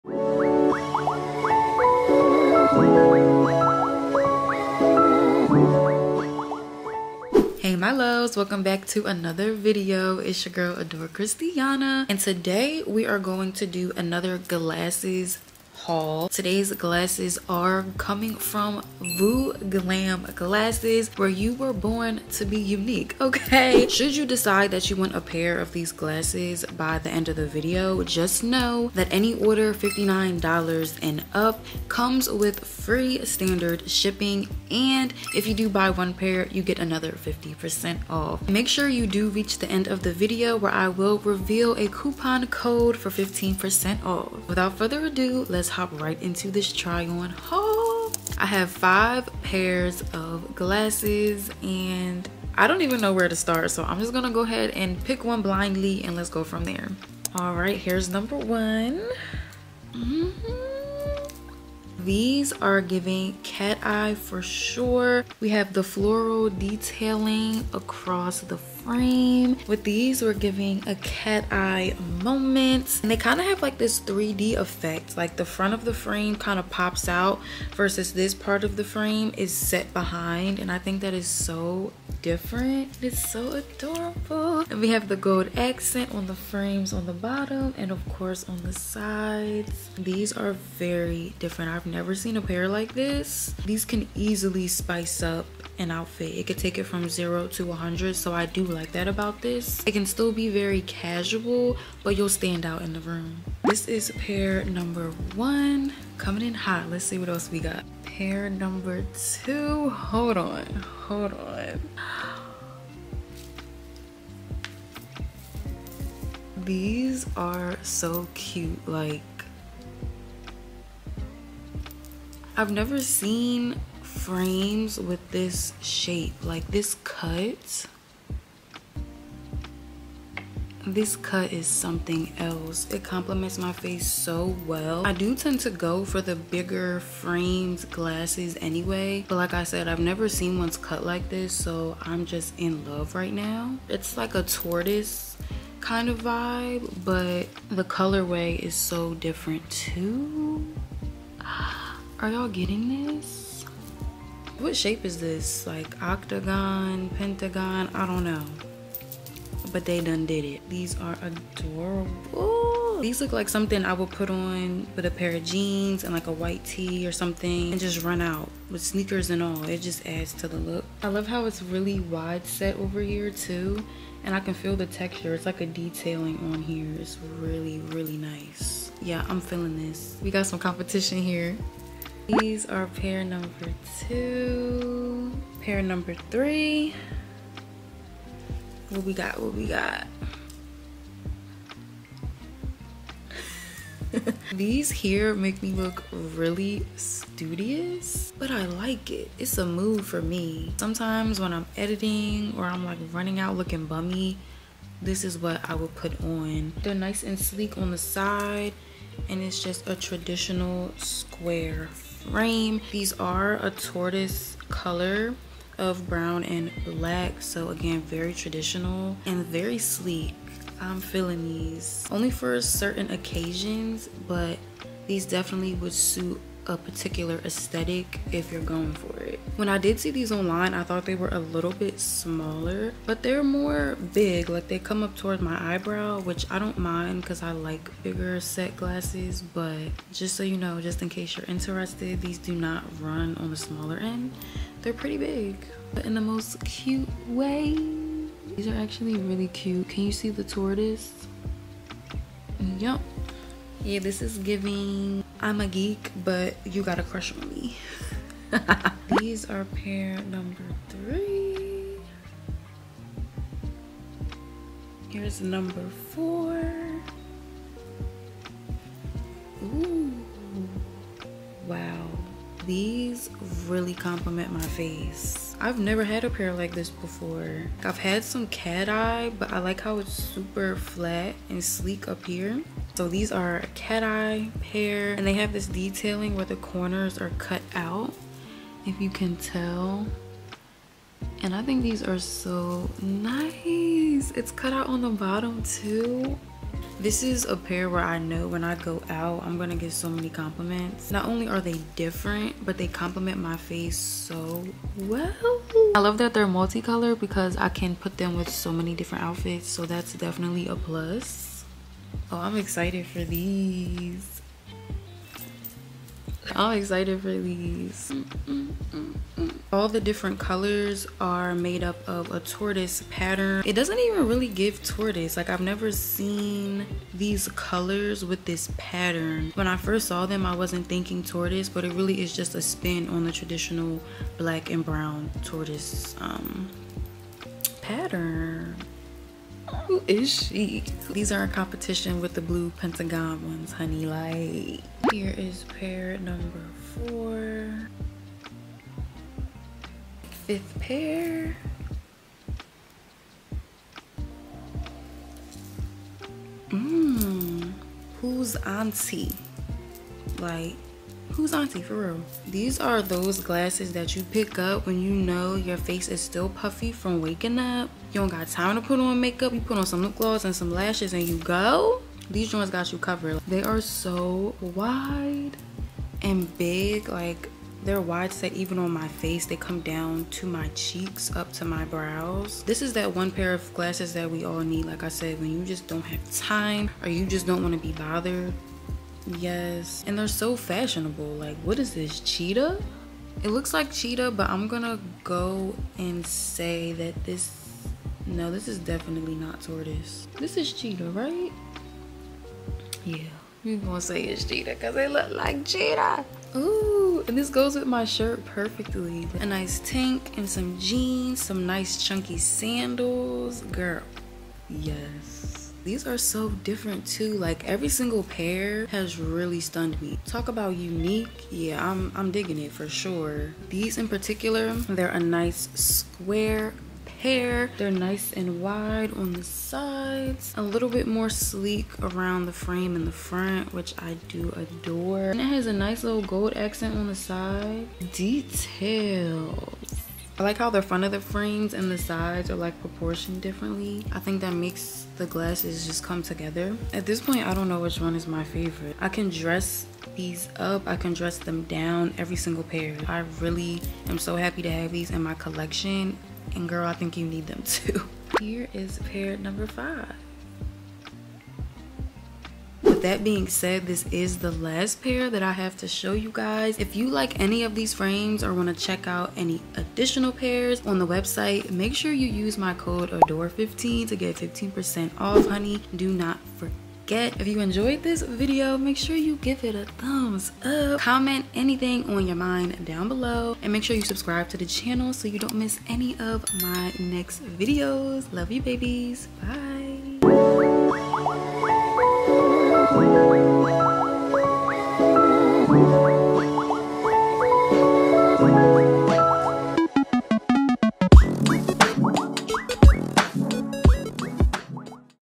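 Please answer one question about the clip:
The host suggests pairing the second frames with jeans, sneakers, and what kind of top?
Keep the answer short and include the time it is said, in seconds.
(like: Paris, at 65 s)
A white tee, at 166 s.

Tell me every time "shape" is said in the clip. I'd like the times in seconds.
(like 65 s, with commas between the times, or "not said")
125 s, 154 s.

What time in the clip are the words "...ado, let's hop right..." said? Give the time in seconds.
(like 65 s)
45 s.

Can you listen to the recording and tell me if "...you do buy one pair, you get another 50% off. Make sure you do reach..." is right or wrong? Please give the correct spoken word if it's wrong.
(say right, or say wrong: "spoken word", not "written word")
right.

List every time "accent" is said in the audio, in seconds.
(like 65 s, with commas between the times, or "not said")
85 s, 436 s.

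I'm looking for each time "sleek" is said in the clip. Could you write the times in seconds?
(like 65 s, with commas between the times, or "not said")
207 s, 219 s, 281 s, 431 s.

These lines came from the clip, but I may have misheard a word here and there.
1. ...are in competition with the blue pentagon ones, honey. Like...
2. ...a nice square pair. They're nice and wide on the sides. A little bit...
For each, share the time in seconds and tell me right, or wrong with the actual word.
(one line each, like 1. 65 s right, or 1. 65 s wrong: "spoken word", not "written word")
1. 341 s right
2. 425 s right.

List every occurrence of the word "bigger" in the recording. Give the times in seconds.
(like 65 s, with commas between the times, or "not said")
136 s, 238 s.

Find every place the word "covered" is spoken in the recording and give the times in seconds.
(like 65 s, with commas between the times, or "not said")
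372 s.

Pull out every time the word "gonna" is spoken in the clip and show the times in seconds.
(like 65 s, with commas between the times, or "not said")
54 s, 299 s, 394 s, 403 s.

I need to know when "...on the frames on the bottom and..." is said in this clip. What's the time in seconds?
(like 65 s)
86 s.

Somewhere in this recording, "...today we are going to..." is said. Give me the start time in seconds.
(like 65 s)
12 s.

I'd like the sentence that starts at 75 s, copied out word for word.
Like the front of the frame kind of pops out versus this part of the frame is set behind.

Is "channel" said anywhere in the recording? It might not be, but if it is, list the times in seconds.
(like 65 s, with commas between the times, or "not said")
484 s.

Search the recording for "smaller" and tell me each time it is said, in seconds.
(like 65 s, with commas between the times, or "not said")
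231 s, 243 s.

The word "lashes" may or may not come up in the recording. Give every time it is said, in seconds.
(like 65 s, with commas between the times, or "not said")
370 s.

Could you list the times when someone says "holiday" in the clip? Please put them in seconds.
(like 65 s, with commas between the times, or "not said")
not said.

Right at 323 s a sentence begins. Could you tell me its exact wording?
It doesn't even really give tortoise.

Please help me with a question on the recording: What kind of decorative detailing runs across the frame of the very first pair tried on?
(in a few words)
Floral.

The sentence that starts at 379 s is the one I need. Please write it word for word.
They come down to my cheeks, up to my brows.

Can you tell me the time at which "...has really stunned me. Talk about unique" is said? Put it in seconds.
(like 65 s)
418 s.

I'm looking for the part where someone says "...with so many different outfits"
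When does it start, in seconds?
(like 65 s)
308 s.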